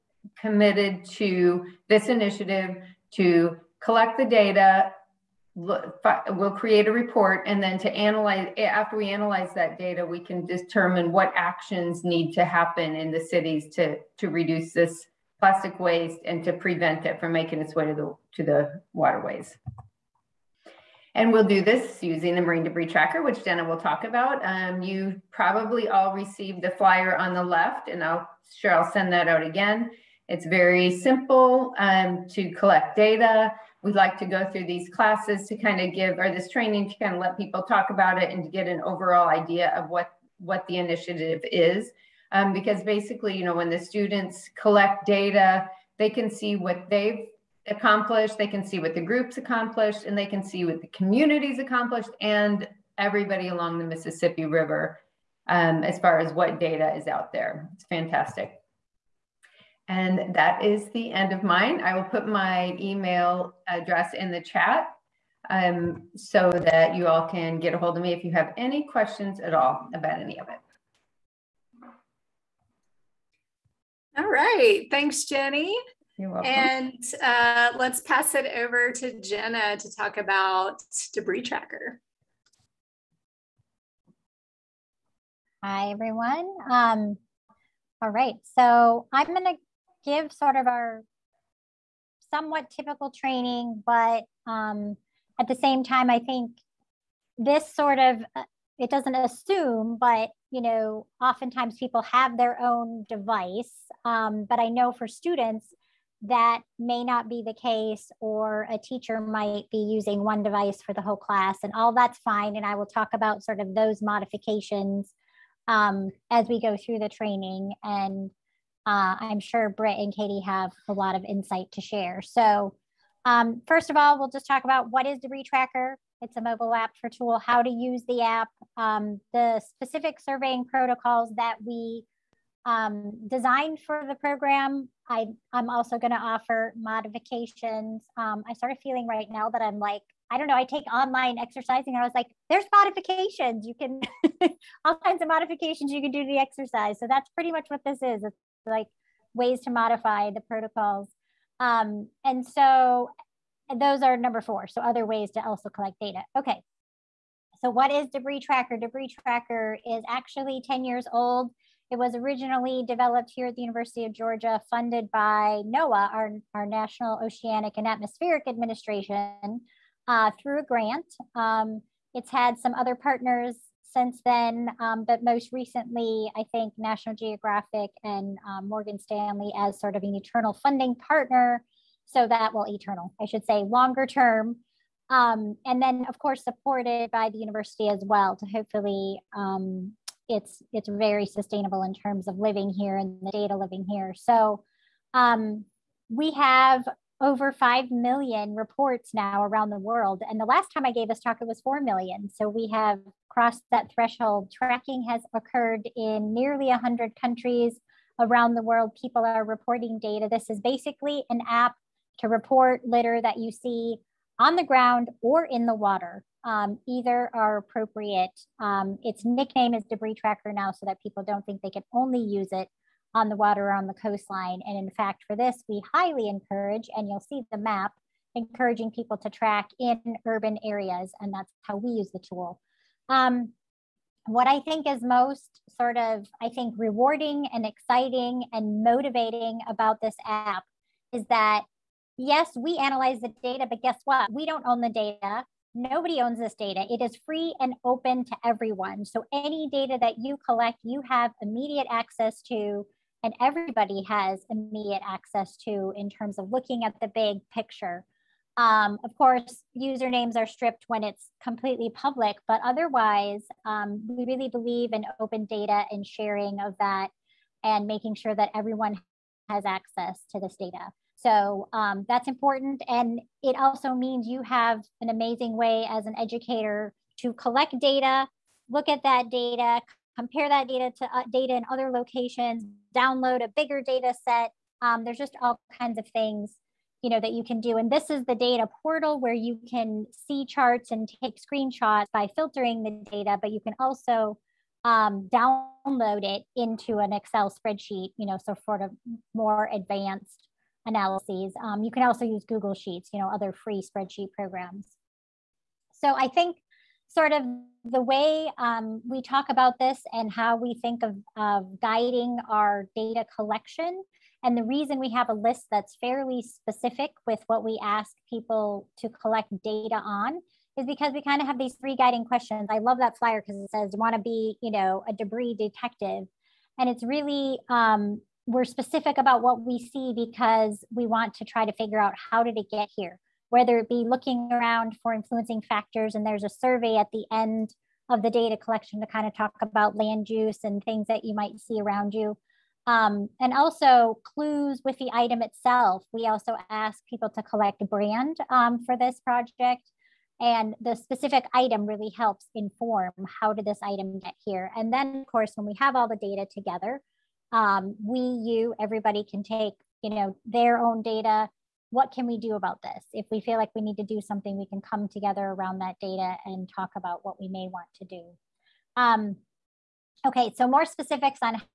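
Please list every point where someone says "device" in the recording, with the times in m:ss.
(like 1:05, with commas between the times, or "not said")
1:43, 1:50.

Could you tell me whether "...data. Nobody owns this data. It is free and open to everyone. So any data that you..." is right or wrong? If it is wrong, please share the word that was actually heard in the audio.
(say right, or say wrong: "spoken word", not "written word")
right.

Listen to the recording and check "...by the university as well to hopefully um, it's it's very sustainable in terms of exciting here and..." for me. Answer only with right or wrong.
wrong.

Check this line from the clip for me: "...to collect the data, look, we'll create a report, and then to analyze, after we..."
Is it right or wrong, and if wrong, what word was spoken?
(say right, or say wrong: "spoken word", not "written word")
right.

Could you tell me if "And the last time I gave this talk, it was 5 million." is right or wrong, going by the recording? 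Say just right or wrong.
wrong.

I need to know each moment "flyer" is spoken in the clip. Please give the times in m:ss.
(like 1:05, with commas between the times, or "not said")
0:26, 5:23.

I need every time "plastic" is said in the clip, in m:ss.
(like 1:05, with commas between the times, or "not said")
0:15.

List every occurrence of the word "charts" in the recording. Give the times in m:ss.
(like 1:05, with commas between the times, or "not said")
4:50.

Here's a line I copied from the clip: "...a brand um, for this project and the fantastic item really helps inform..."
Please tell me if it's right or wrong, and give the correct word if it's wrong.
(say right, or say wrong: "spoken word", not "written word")
wrong: "specific", not "fantastic".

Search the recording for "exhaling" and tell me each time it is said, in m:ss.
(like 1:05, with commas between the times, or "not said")
not said.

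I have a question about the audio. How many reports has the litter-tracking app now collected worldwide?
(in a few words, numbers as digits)
over 5 million.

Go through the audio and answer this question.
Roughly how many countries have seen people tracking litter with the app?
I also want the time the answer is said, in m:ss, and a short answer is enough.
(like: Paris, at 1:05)
nearly 100, at 3:26.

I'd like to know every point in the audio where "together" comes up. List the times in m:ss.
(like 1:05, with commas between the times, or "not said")
5:56, 6:05.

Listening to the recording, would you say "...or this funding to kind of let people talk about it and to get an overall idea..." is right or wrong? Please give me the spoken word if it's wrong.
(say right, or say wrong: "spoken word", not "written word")
wrong: "training", not "funding".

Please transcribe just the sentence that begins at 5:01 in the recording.
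Um, you can also use Google Sheets, you know, other free spreadsheet programs.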